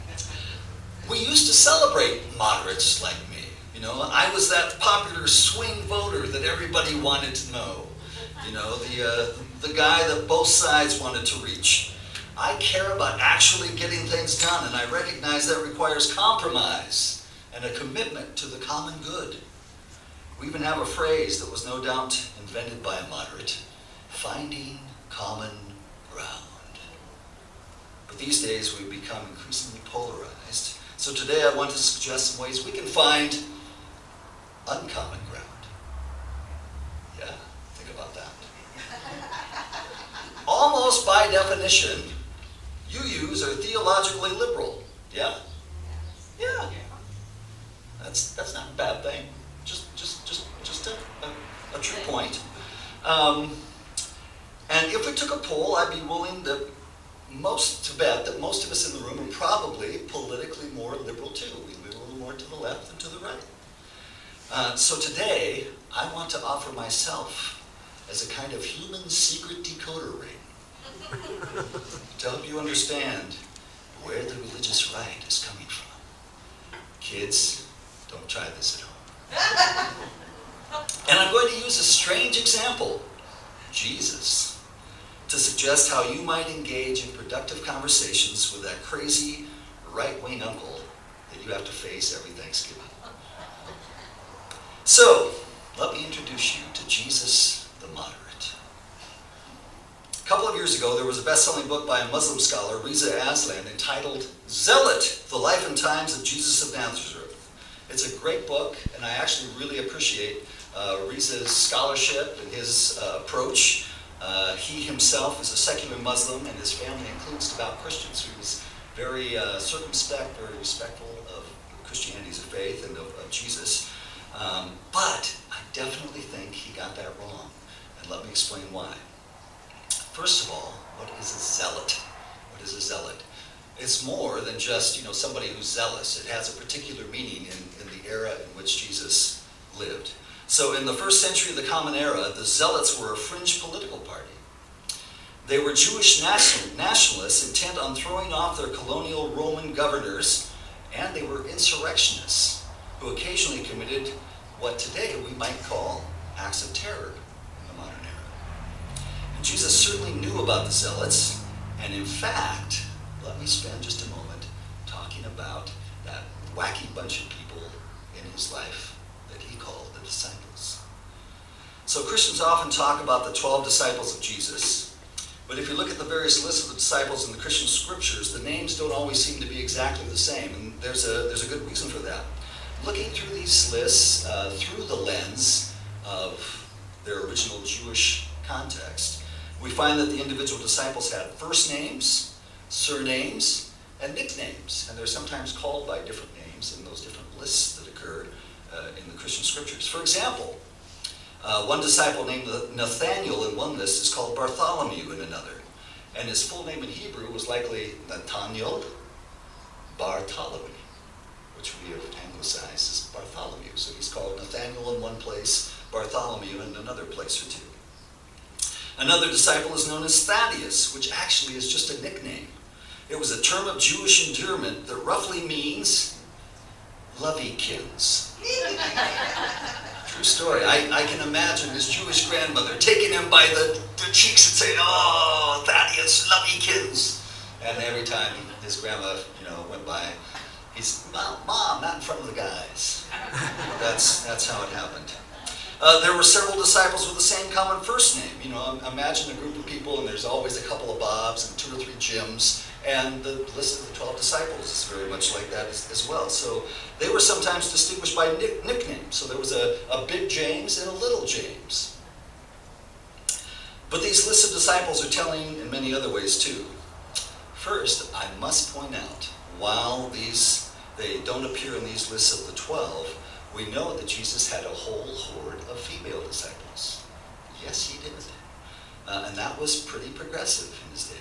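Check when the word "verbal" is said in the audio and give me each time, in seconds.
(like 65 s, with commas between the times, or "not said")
not said.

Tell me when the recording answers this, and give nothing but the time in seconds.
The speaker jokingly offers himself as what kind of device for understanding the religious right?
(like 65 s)
68 s.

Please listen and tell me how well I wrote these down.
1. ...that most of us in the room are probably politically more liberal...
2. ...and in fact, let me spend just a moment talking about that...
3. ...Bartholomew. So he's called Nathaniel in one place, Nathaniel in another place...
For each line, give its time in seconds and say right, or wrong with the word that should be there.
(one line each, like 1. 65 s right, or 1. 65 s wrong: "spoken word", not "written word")
1. 58 s right
2. 161 s right
3. 213 s wrong: "Bartholomew", not "Nathaniel".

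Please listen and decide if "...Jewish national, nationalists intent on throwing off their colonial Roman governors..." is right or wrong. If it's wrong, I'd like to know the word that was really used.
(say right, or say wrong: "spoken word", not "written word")
right.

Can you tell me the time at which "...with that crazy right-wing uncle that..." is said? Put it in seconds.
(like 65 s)
88 s.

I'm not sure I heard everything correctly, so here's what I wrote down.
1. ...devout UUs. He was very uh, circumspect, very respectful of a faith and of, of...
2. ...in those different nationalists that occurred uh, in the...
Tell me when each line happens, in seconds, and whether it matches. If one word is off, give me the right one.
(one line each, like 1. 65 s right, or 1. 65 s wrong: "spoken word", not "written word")
1. 117 s wrong: "Christians", not "UUs"
2. 196 s wrong: "lists", not "nationalists".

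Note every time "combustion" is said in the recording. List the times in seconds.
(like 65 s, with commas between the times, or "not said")
not said.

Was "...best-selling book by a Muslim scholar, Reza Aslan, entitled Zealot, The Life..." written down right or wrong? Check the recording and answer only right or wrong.
right.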